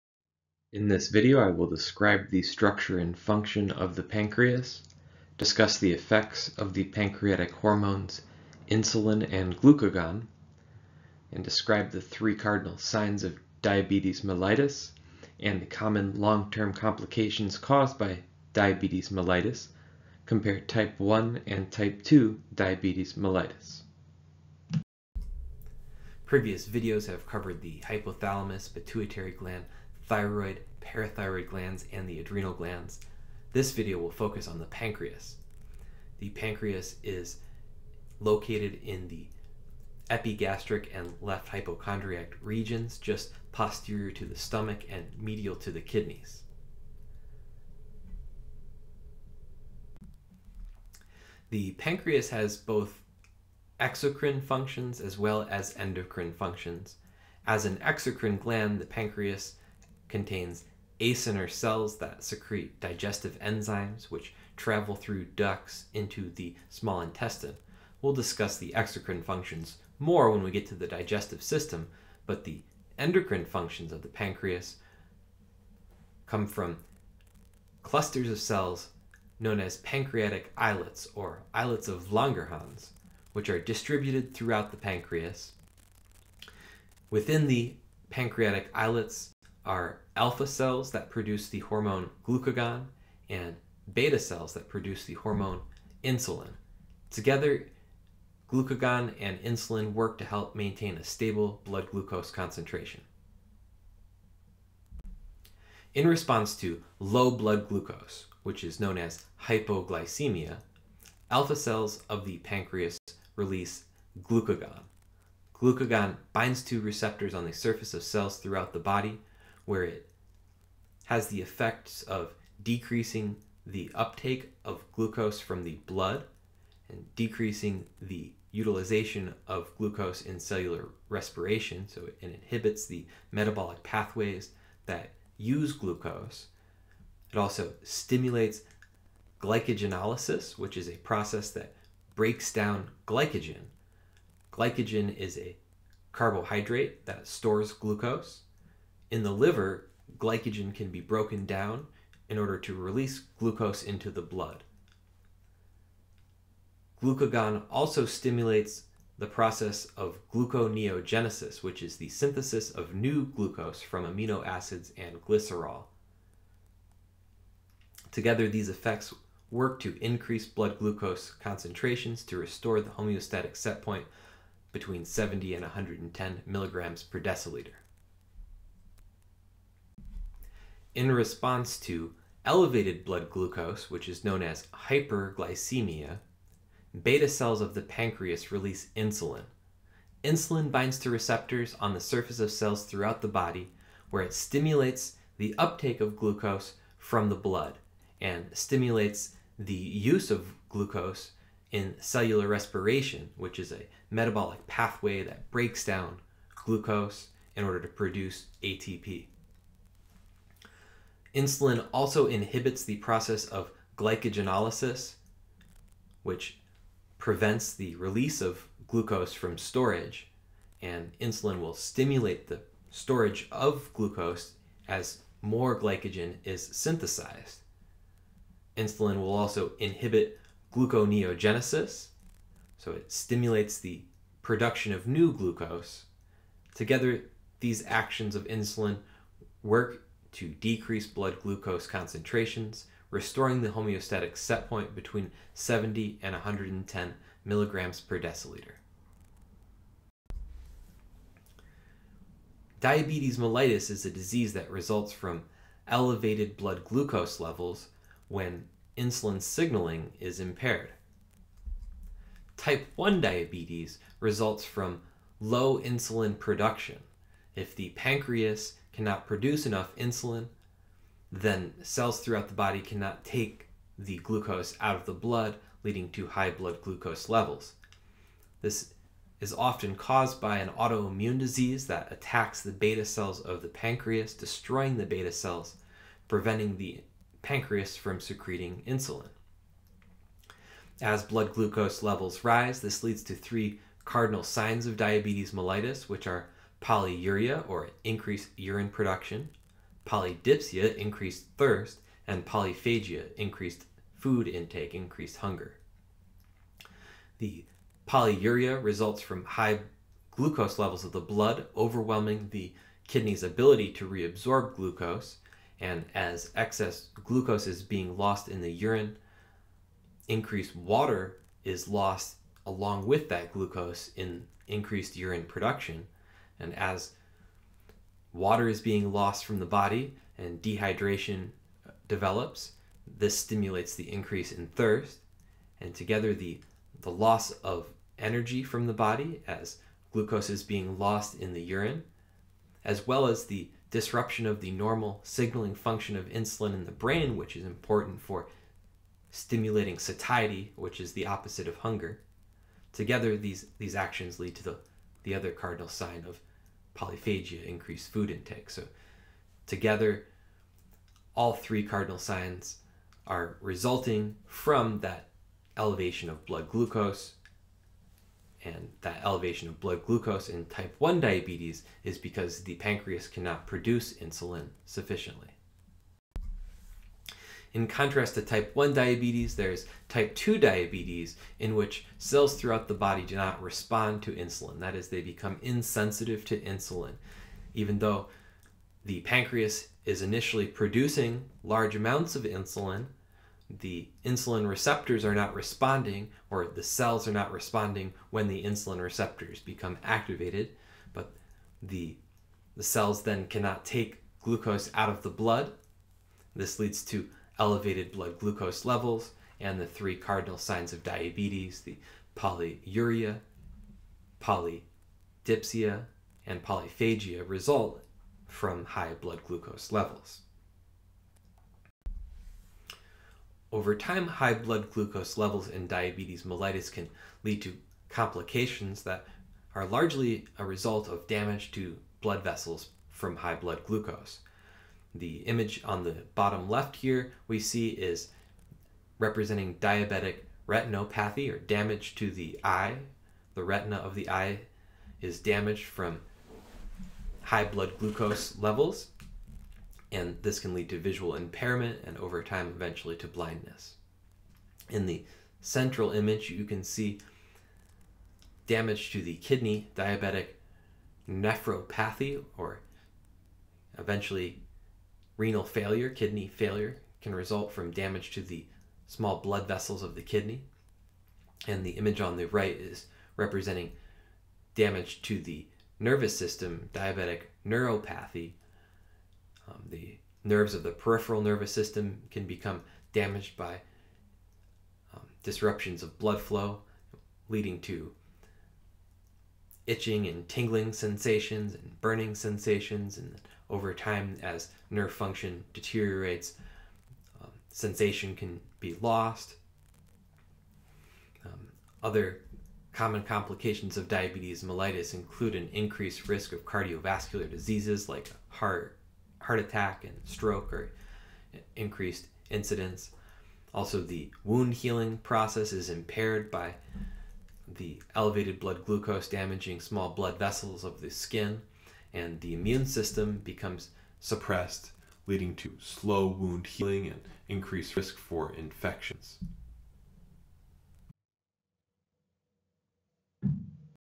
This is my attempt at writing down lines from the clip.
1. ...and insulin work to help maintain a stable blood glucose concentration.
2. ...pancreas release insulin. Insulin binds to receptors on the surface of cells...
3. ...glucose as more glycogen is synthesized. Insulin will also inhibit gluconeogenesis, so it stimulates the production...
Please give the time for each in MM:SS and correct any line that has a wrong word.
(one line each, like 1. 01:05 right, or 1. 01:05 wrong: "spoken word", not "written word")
1. 01:39 right
2. 03:07 right
3. 03:43 right.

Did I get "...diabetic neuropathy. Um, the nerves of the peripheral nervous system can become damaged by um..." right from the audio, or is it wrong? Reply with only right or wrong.
right.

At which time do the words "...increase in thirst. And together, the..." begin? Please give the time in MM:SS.
05:34.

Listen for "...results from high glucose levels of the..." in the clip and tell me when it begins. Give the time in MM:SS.
05:08.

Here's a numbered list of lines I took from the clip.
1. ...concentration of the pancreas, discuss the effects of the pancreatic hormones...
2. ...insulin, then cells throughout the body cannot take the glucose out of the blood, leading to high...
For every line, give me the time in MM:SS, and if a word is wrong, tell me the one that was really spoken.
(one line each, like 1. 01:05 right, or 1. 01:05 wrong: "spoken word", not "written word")
1. 00:03 wrong: "function", not "concentration"
2. 04:29 right.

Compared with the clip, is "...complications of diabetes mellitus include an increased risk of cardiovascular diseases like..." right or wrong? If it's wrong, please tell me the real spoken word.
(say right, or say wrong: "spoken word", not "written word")
right.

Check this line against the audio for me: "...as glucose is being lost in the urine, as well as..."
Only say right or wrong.
right.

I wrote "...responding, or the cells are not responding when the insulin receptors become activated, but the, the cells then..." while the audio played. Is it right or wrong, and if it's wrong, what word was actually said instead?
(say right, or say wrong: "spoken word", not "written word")
right.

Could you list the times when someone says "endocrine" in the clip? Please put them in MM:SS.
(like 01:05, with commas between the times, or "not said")
00:55, 01:12.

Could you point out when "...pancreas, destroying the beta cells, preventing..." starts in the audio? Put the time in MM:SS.
04:43.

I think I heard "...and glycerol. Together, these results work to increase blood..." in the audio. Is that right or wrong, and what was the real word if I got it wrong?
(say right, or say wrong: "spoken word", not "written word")
wrong: "effects", not "results".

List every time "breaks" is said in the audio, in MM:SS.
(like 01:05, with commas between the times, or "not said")
02:22, 03:25.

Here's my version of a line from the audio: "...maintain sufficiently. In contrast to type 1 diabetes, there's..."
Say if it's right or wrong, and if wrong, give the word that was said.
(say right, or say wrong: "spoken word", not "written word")
wrong: "insulin", not "maintain".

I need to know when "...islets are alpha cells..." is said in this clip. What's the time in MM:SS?
01:28.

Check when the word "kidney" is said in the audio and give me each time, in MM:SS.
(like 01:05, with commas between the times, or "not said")
00:45, 05:13, 07:39, 07:46, 07:50.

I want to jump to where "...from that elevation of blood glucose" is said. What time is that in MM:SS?
06:04.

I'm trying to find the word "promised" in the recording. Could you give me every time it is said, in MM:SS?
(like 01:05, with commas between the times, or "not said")
not said.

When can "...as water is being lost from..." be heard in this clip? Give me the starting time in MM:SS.
05:26.